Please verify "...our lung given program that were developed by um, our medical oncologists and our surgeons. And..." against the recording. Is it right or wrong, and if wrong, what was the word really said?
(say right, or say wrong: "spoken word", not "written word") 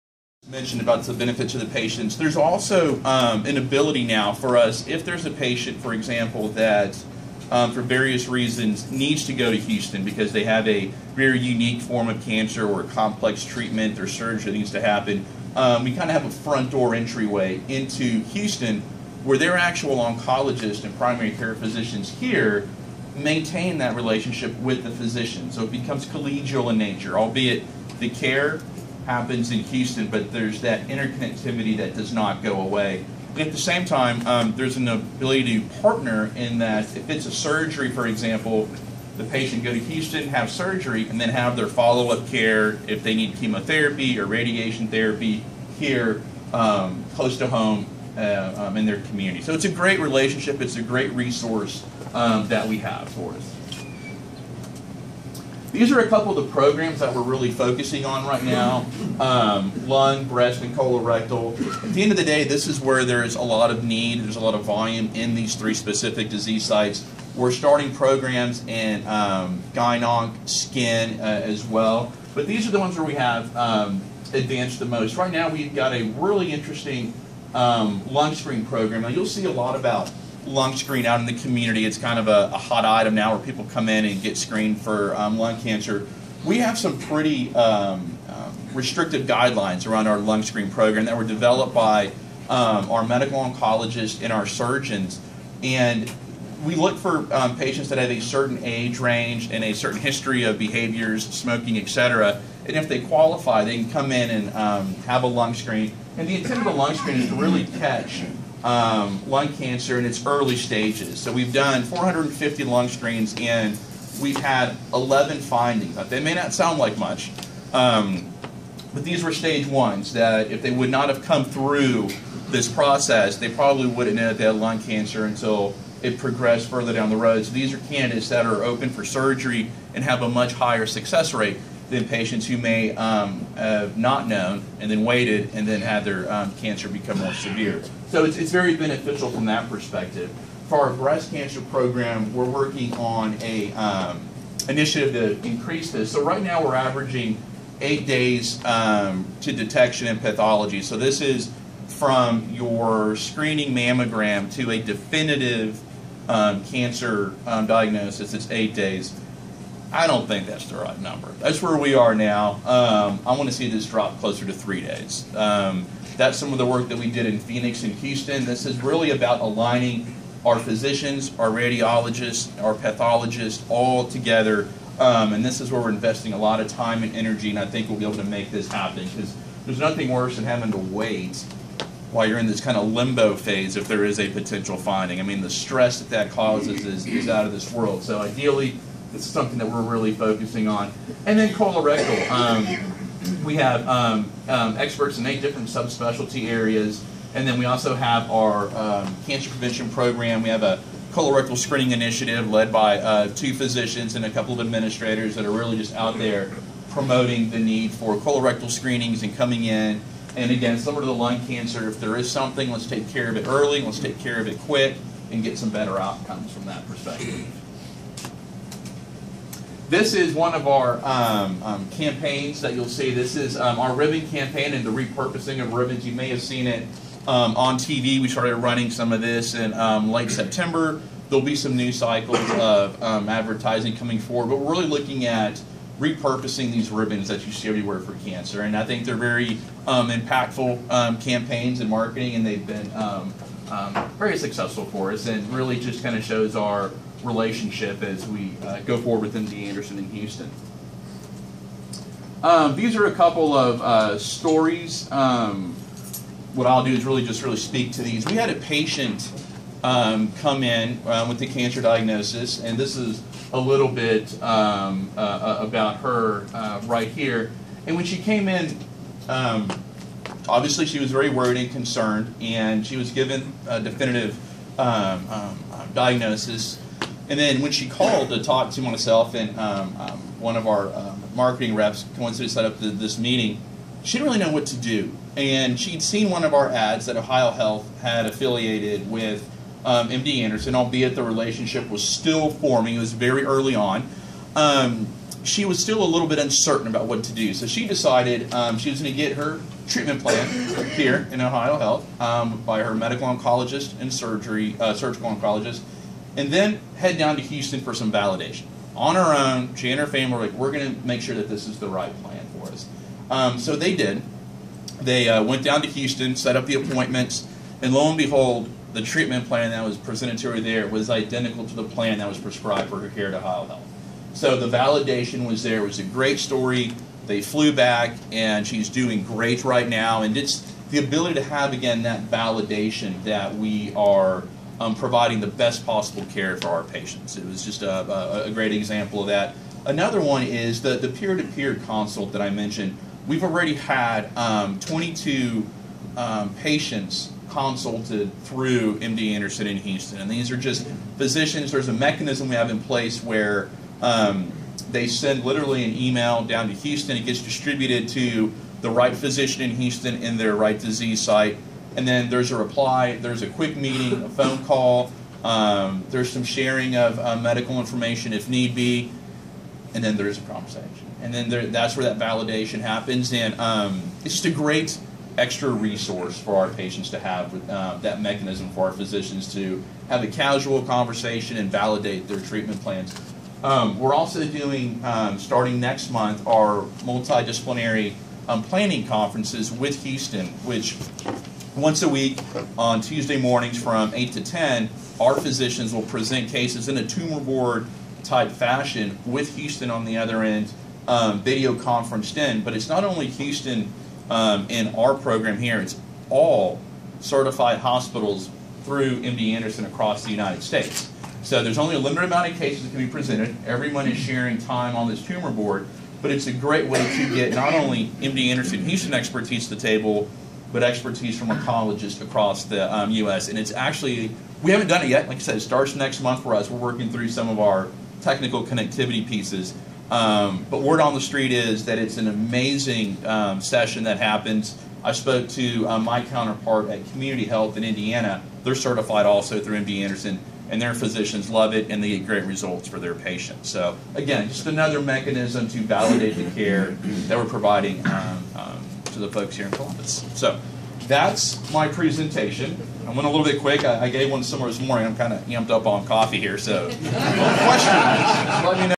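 wrong: "screen", not "given".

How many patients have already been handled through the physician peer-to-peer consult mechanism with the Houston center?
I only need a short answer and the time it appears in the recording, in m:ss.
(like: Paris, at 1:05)
22, at 5:44.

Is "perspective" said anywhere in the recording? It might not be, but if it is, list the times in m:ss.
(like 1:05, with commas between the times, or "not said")
2:19, 3:36.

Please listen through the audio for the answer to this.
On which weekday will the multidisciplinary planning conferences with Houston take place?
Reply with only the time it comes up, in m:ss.
6:32.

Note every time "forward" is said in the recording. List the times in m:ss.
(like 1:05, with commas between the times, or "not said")
3:54, 4:08.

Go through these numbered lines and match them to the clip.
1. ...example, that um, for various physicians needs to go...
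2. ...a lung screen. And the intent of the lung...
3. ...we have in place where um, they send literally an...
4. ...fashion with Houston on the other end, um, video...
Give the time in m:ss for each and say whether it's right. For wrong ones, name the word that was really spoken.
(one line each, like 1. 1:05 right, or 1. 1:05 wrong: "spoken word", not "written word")
1. 0:05 wrong: "reasons", not "physicians"
2. 1:45 right
3. 5:52 right
4. 6:38 right.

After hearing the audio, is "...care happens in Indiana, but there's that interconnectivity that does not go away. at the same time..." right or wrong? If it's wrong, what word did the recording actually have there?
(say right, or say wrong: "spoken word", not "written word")
wrong: "Houston", not "Indiana".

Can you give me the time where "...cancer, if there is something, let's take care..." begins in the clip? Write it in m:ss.
3:31.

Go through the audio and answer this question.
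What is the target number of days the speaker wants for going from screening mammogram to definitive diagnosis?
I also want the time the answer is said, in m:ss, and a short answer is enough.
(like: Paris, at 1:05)
3 days, at 2:44.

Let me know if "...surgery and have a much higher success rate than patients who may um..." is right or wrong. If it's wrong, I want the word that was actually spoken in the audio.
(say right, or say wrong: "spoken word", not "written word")
right.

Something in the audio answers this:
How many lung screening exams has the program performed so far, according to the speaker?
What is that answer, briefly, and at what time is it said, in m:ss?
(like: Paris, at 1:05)
450, at 1:51.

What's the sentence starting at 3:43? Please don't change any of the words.
This is um, our ribbon campaign and the repurposing of ribbons.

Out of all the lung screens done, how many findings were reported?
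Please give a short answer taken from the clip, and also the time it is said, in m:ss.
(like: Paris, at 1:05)
11, at 1:54.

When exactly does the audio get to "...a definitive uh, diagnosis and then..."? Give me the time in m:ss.
4:33.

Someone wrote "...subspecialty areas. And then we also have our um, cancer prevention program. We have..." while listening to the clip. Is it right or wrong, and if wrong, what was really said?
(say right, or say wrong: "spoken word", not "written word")
right.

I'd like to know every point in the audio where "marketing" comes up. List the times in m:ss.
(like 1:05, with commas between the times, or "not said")
4:01, 4:41.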